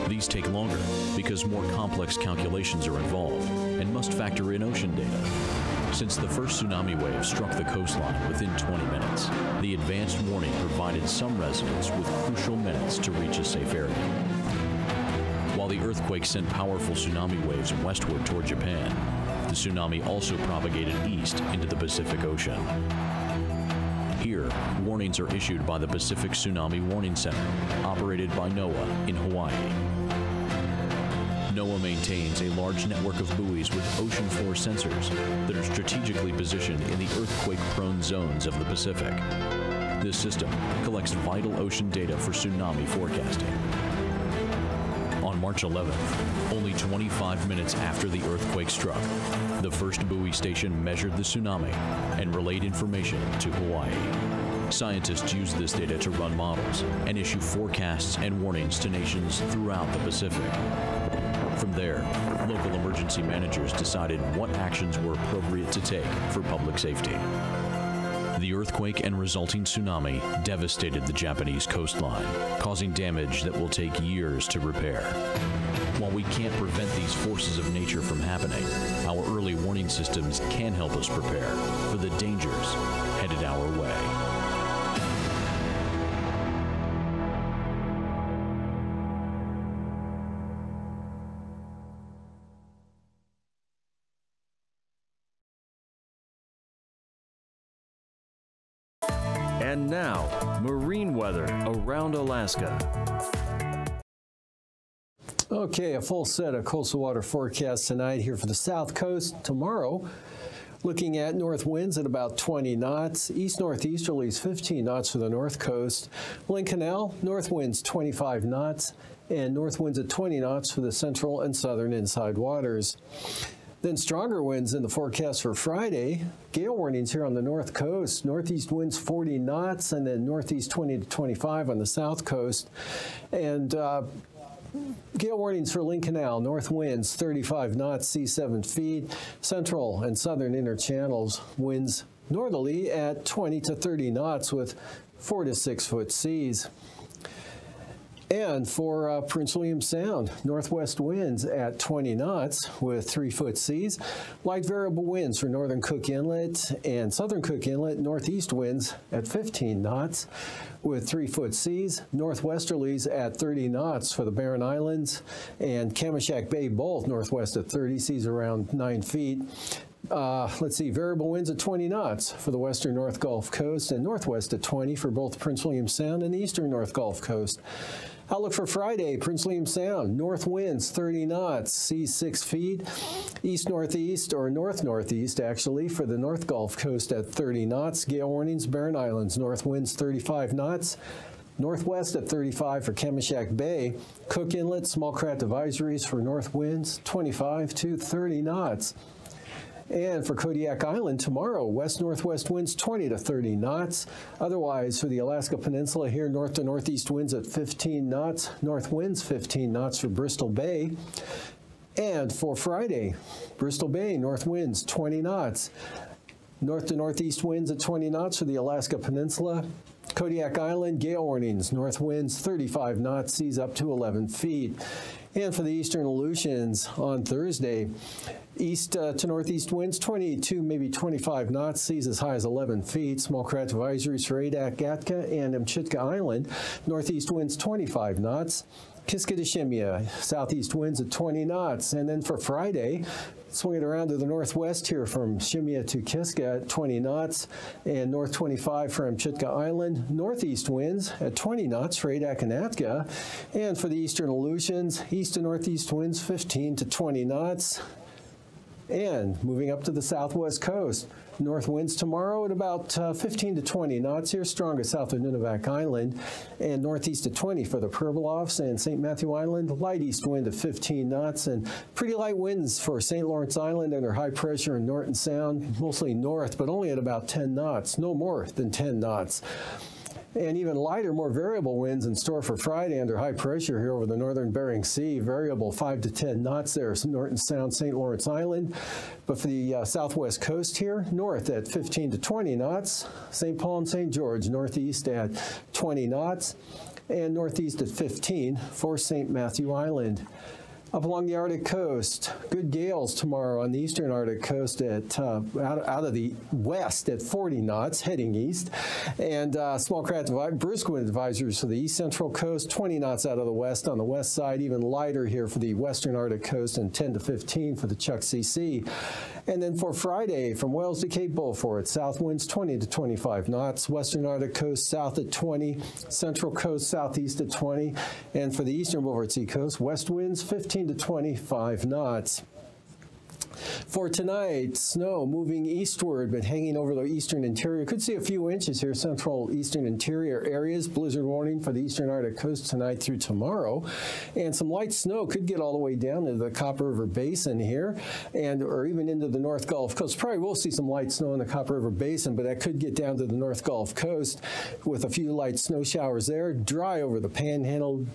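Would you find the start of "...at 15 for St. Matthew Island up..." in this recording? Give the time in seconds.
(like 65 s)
297 s.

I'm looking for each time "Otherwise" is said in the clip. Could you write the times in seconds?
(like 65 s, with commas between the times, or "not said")
204 s.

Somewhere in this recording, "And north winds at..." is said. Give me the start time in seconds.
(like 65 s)
119 s.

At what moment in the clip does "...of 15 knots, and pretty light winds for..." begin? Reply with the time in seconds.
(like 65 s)
270 s.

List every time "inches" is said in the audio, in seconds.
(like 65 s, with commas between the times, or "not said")
338 s.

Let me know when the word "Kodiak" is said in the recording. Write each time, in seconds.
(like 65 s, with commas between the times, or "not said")
200 s, 220 s.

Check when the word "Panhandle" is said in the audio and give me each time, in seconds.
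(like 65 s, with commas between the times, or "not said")
357 s.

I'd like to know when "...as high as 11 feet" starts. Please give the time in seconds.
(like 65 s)
232 s.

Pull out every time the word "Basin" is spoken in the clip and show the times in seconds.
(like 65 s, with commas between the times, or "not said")
347 s, 351 s.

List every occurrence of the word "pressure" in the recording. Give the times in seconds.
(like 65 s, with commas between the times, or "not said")
274 s, 283 s.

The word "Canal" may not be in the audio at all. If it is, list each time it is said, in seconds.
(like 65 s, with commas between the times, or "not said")
116 s, 136 s.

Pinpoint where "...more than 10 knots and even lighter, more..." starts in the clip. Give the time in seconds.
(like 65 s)
278 s.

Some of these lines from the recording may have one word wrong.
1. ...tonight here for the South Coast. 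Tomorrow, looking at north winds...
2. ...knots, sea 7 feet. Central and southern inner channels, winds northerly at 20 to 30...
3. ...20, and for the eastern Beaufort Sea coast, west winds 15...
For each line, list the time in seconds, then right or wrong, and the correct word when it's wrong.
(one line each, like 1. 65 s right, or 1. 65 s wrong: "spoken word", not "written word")
1. 107 s right
2. 137 s right
3. 327 s right.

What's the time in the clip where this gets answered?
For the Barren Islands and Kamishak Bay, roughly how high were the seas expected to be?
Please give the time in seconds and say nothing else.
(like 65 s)
168 s.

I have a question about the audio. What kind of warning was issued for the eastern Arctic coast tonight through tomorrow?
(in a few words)
Blizzard warning.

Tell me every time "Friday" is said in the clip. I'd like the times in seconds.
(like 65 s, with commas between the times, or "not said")
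125 s, 178 s, 212 s, 242 s, 282 s, 319 s.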